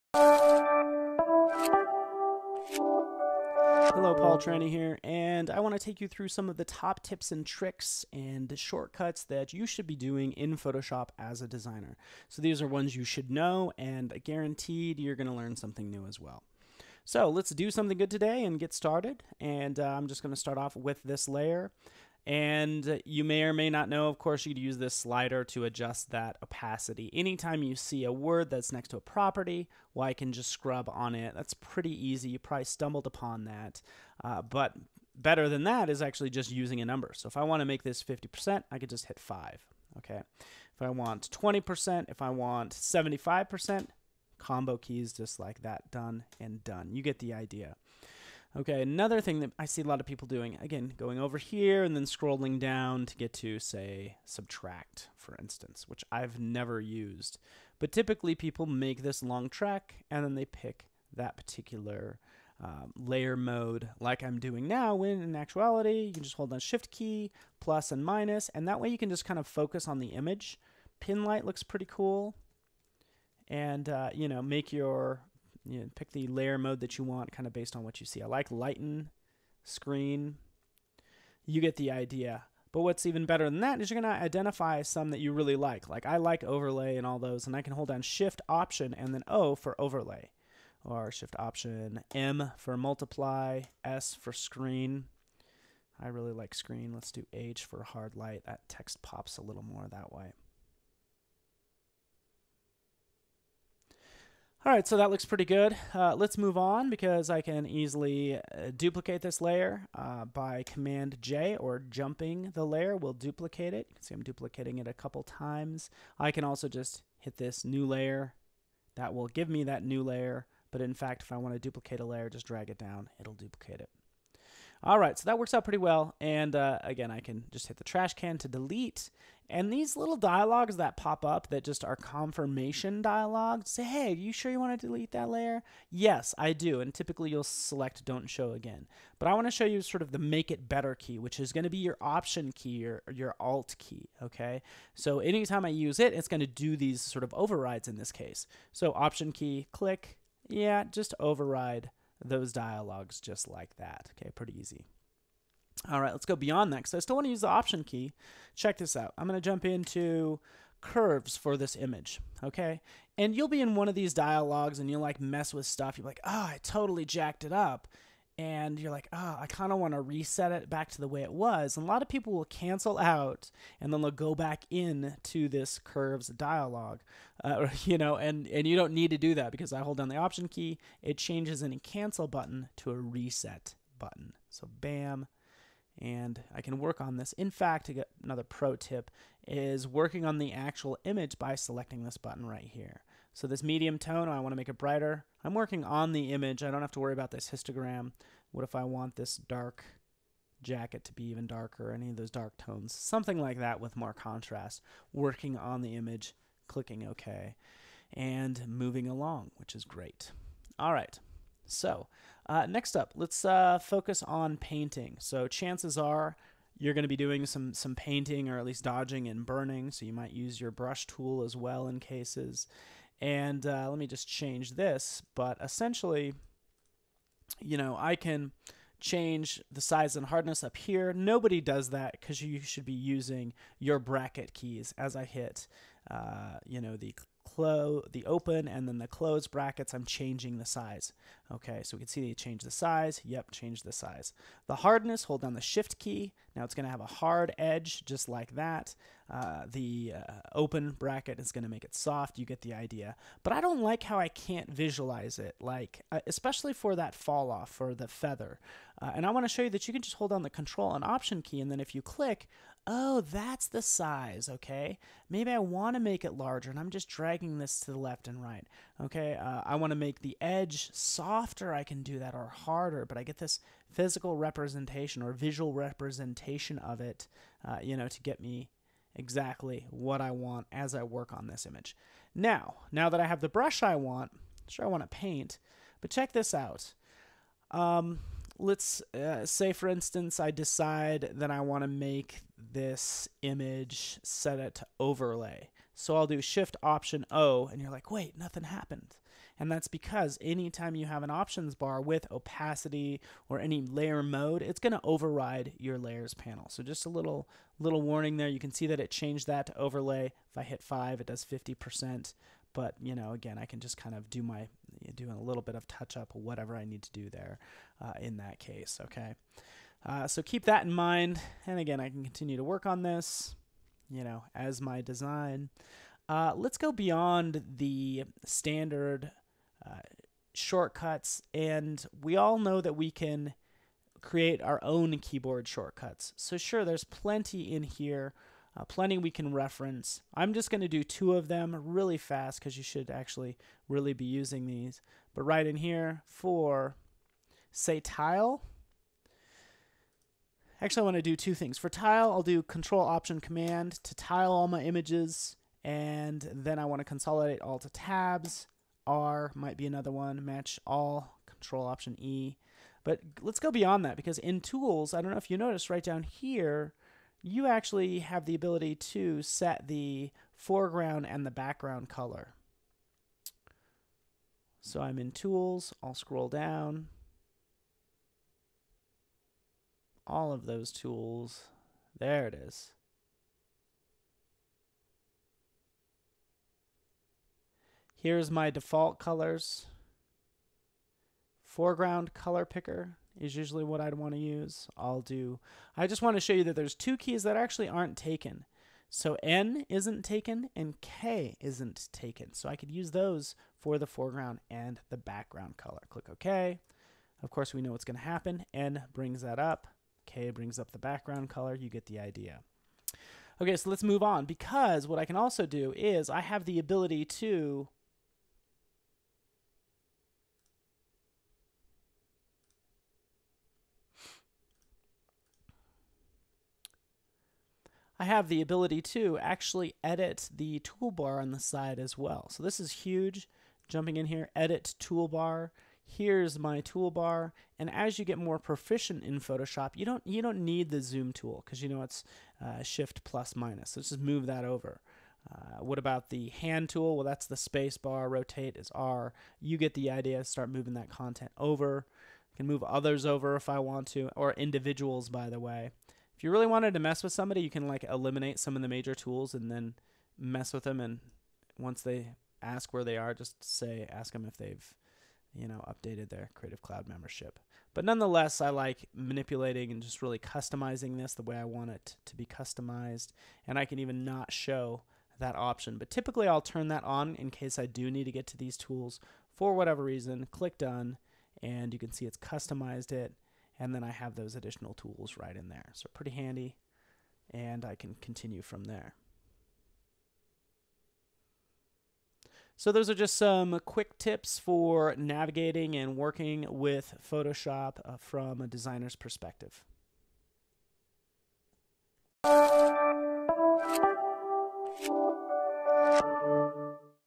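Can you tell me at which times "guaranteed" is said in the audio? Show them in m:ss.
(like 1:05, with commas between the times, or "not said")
0:14.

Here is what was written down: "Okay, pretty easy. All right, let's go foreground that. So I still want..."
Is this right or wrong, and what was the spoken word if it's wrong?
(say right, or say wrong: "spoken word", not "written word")
wrong: "beyond", not "foreground".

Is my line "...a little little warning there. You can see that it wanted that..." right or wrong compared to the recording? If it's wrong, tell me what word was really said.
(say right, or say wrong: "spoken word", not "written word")
wrong: "changed", not "wanted".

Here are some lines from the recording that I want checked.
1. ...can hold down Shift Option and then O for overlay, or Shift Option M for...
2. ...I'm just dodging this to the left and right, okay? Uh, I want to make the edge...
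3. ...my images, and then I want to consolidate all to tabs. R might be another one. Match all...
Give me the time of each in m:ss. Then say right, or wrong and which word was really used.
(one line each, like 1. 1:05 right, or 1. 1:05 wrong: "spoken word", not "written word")
1. 1:27 right
2. 4:26 wrong: "dragging", not "dodging"
3. 5:54 right.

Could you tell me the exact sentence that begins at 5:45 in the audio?
But right in here for, say, tile.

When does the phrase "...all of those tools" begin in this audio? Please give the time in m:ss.
6:20.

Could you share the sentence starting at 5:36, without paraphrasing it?
So sure, there's plenty in here uh, plenty we can reference.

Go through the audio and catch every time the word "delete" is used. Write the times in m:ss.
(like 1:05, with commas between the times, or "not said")
2:08, 2:14.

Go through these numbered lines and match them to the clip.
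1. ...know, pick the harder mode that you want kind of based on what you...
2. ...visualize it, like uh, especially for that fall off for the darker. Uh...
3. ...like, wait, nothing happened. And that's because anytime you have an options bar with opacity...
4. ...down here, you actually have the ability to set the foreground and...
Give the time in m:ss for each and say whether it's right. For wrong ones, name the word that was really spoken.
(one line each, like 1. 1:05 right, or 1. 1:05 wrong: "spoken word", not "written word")
1. 1:15 wrong: "layer", not "harder"
2. 4:14 wrong: "feather", not "darker"
3. 4:57 right
4. 6:06 right.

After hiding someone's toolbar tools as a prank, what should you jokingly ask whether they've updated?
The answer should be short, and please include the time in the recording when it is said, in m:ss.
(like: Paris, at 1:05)
Creative Cloud membership, at 7:46.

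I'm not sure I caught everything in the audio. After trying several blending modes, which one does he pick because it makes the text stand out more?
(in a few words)
hard light.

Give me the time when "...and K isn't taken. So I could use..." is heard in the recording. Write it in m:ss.
6:40.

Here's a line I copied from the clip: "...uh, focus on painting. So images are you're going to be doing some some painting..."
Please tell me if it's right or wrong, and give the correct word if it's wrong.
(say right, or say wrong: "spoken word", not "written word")
wrong: "chances", not "images".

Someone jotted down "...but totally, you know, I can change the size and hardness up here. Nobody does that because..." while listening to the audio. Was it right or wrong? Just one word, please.
wrong.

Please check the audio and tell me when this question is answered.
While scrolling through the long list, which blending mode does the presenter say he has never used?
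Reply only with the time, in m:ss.
0:54.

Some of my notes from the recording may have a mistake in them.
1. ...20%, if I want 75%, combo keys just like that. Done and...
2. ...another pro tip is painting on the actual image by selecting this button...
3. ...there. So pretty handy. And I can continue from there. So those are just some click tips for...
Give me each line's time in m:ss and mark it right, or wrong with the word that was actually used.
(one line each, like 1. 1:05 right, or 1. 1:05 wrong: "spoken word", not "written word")
1. 0:41 right
2. 3:08 wrong: "working", not "painting"
3. 8:05 wrong: "quick", not "click".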